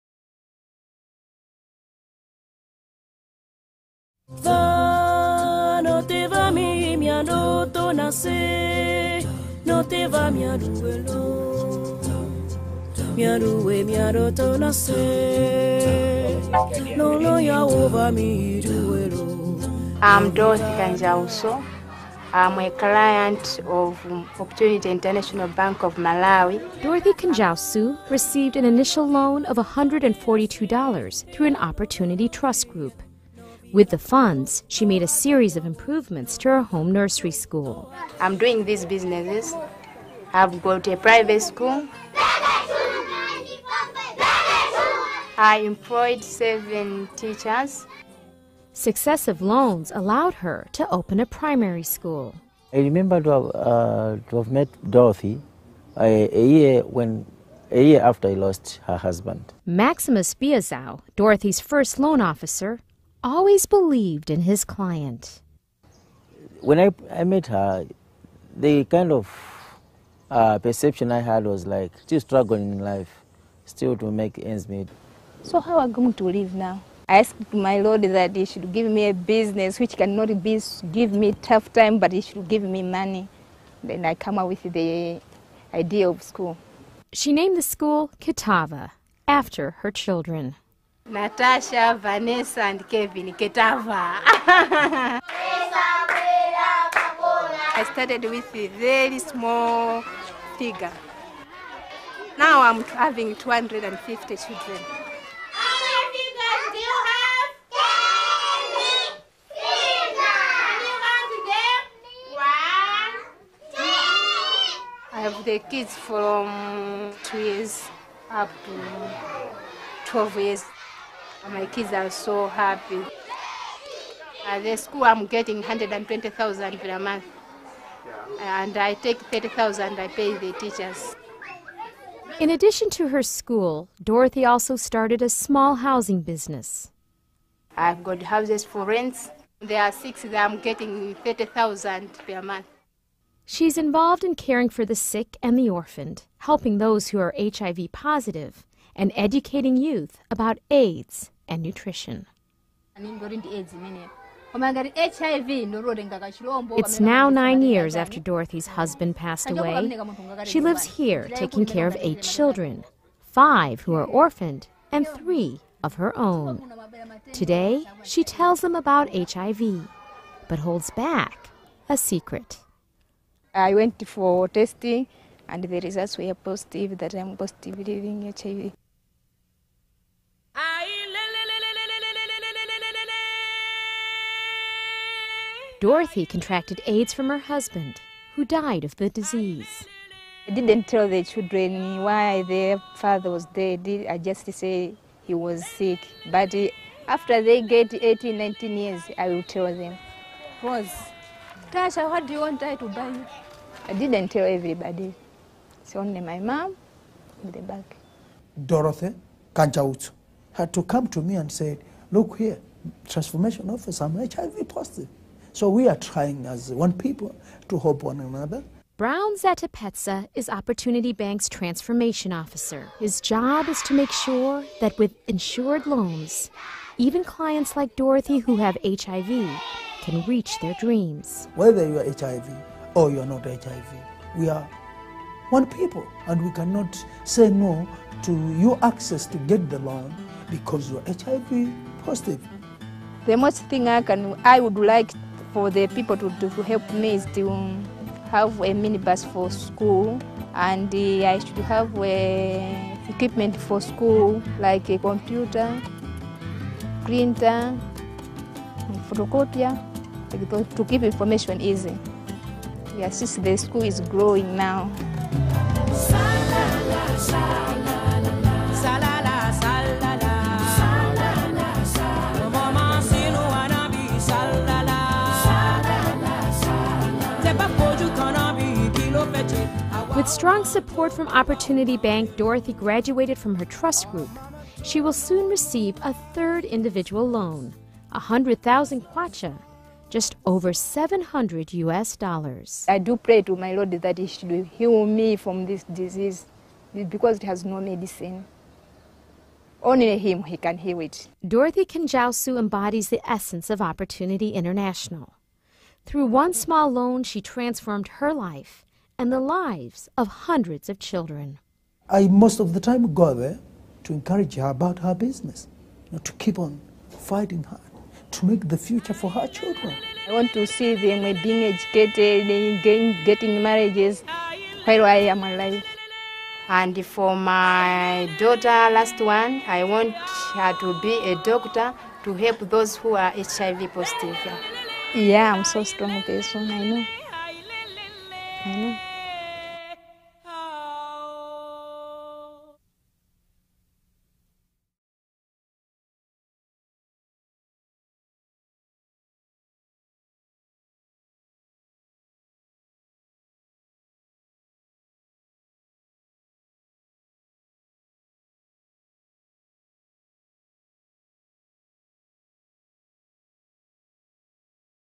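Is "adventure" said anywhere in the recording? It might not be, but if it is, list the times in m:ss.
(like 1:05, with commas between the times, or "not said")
not said.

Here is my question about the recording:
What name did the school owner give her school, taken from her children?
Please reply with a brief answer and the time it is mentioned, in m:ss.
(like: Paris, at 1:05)
Kitava, at 1:28.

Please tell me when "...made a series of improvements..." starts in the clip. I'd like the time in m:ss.
0:34.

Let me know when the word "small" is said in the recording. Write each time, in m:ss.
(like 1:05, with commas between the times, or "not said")
1:39, 2:15, 5:06.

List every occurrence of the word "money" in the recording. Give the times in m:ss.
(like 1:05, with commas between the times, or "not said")
1:22.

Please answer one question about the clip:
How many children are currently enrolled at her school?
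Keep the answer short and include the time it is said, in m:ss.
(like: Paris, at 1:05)
250, at 1:43.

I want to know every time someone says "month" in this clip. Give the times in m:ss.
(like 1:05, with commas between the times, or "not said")
2:06, 2:22.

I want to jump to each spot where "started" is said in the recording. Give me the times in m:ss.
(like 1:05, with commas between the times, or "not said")
1:37, 2:14.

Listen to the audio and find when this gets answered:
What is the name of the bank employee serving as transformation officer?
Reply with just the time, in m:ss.
3:38.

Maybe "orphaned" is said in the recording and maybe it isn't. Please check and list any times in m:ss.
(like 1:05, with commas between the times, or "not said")
2:25, 2:44.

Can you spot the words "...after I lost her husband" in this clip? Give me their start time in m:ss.
0:58.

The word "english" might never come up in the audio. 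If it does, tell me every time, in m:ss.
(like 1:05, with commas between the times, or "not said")
not said.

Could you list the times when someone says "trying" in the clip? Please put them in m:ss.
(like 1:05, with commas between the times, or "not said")
3:35.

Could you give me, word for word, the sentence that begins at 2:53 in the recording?
I went for testing, and the results were positive that I'm positive living HIV.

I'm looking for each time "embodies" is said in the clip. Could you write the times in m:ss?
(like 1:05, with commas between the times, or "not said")
5:02.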